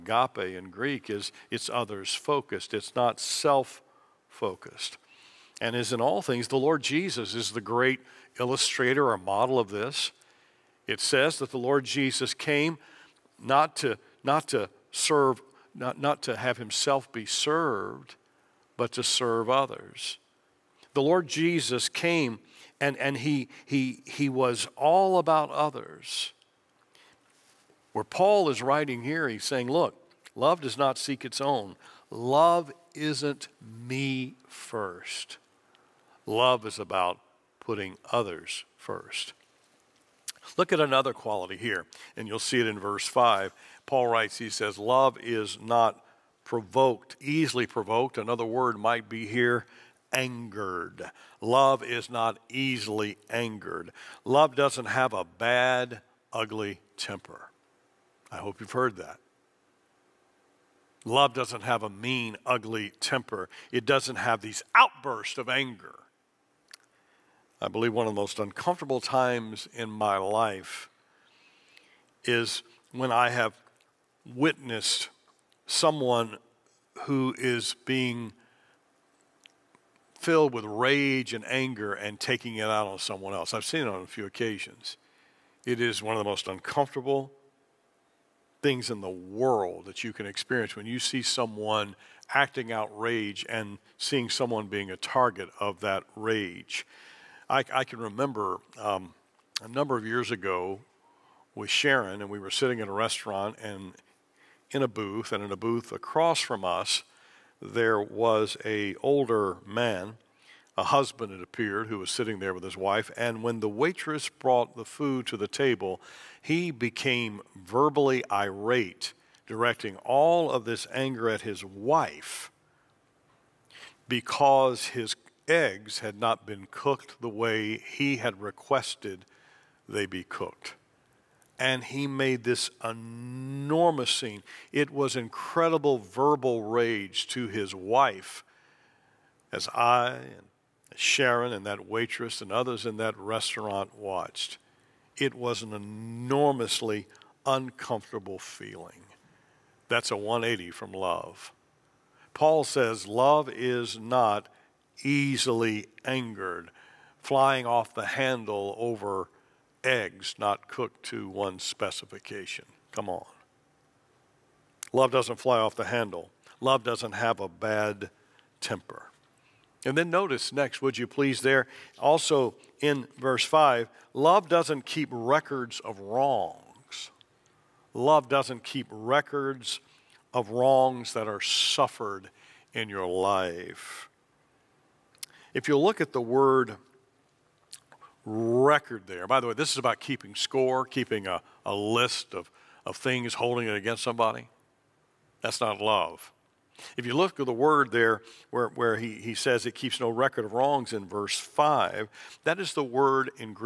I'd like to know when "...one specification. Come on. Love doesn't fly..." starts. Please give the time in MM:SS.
02:41.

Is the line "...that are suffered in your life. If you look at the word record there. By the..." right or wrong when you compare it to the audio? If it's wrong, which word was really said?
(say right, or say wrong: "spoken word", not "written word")
right.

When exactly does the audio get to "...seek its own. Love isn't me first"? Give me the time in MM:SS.
00:30.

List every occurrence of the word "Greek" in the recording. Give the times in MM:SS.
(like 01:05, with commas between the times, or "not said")
00:00.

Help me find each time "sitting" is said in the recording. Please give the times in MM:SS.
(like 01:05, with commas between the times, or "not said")
01:42, 01:52.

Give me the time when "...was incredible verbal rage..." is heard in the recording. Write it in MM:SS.
02:14.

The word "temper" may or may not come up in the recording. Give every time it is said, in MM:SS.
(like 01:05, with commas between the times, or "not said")
00:56, 01:02, 02:48.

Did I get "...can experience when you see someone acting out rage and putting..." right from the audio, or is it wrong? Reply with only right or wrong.
wrong.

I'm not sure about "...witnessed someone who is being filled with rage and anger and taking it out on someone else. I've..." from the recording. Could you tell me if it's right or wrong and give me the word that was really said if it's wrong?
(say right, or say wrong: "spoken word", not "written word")
right.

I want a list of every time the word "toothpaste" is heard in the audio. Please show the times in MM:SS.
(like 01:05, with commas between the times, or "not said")
not said.